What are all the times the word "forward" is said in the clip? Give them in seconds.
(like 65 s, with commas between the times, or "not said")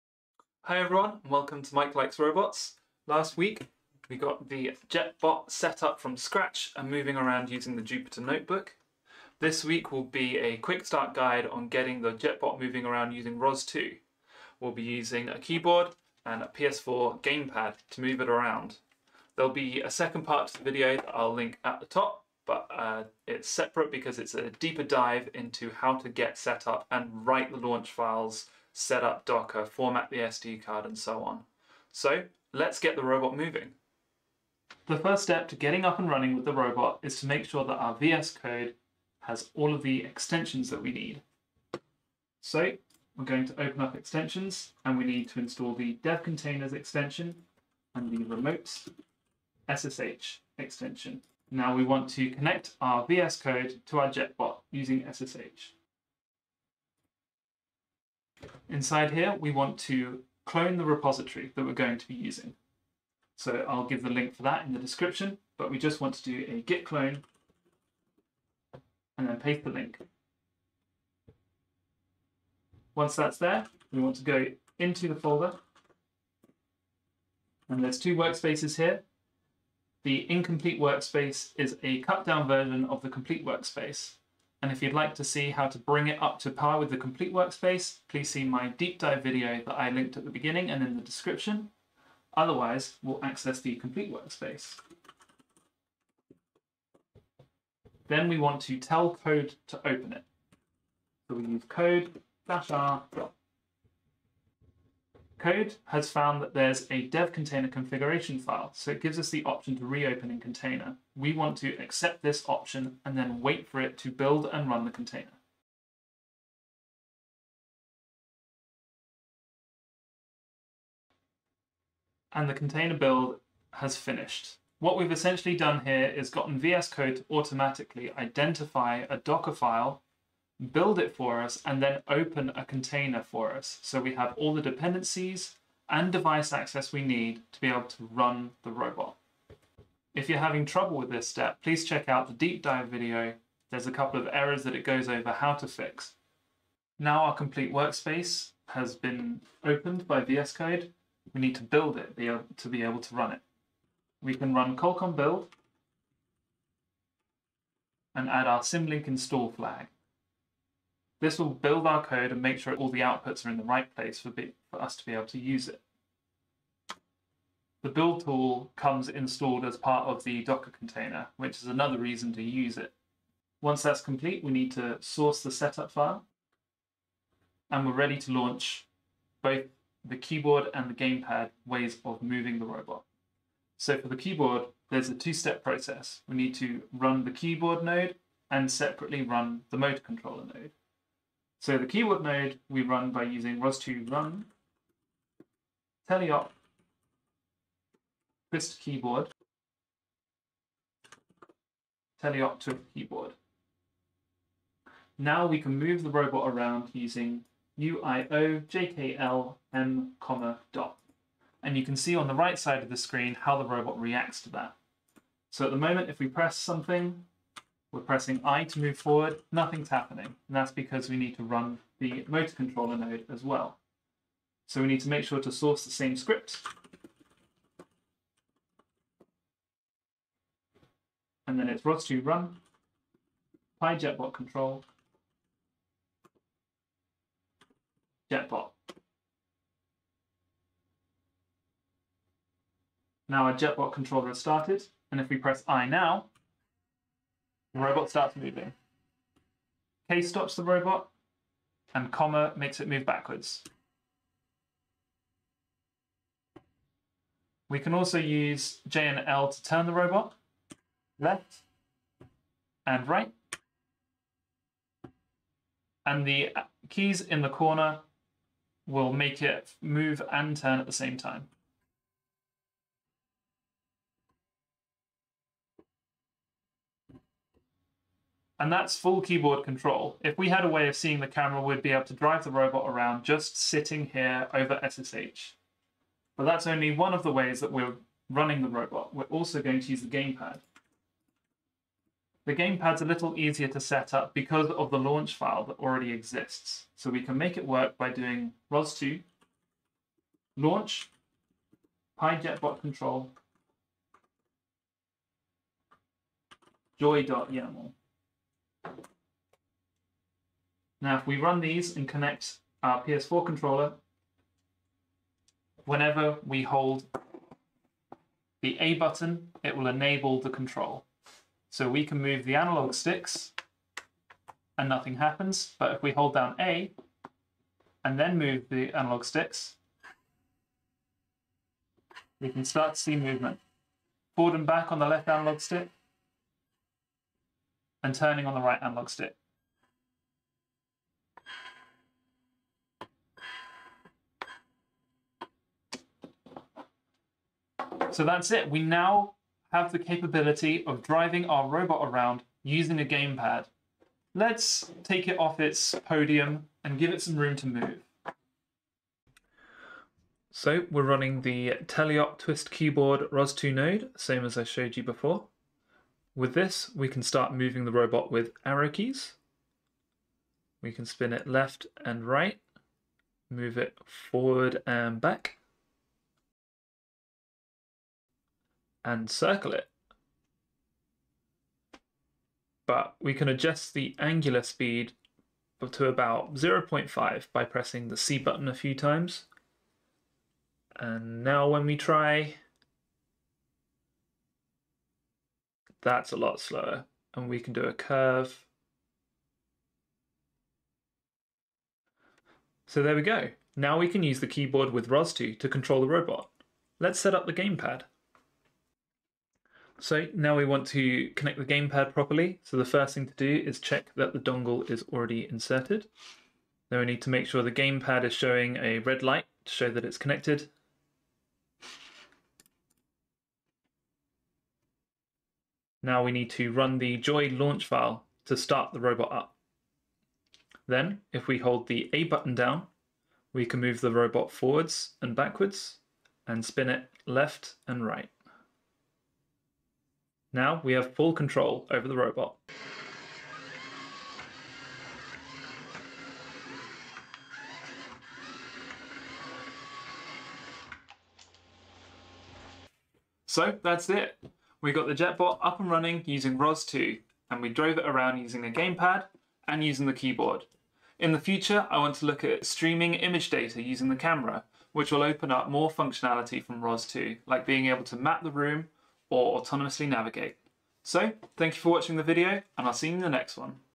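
218 s, 334 s, 374 s, 434 s.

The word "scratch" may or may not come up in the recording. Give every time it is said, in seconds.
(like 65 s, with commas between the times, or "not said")
6 s.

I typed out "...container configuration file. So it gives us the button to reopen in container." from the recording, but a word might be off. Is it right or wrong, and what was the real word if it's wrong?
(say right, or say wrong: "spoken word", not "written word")
wrong: "option", not "button".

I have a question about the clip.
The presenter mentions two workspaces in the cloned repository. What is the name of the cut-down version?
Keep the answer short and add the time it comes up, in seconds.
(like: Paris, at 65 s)
Incomplete workspace, at 80 s.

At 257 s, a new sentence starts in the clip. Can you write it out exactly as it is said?
We can also use J and L to turn the robot left and right.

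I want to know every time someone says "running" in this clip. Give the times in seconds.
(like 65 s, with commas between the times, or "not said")
36 s, 288 s, 361 s, 455 s.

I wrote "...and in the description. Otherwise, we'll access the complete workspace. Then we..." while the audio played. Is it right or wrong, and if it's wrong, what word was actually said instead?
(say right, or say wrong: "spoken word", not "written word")
right.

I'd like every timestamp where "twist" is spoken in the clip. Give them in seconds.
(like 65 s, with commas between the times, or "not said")
198 s, 362 s.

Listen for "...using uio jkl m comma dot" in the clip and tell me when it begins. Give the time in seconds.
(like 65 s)
206 s.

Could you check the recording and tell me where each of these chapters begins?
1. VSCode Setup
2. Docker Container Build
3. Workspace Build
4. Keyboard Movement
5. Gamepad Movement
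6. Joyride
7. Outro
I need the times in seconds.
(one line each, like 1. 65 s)
1. 34 s
2. 104 s
3. 146 s
4. 199 s
5. 297 s
6. 359 s
7. 452 s.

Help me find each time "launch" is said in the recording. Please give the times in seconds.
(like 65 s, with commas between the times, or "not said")
27 s, 178 s, 294 s, 300 s, 427 s.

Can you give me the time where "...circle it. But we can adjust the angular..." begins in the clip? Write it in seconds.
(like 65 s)
379 s.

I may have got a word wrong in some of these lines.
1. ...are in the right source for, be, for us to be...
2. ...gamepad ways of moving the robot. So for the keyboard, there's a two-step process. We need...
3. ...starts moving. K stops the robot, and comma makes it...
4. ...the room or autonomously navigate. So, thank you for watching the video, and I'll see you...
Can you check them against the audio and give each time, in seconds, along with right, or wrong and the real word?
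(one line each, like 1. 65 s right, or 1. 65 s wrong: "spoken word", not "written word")
1. 163 s wrong: "place", not "source"
2. 180 s right
3. 248 s right
4. 468 s right.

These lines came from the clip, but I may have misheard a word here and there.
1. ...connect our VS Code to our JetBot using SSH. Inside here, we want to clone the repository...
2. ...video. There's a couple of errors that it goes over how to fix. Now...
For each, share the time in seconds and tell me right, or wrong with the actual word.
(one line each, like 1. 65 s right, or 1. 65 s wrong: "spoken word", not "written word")
1. 52 s right
2. 142 s right.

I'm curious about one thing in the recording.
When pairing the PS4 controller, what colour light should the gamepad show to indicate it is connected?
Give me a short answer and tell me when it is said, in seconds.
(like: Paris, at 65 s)
Red, at 418 s.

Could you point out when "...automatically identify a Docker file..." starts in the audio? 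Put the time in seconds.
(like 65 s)
127 s.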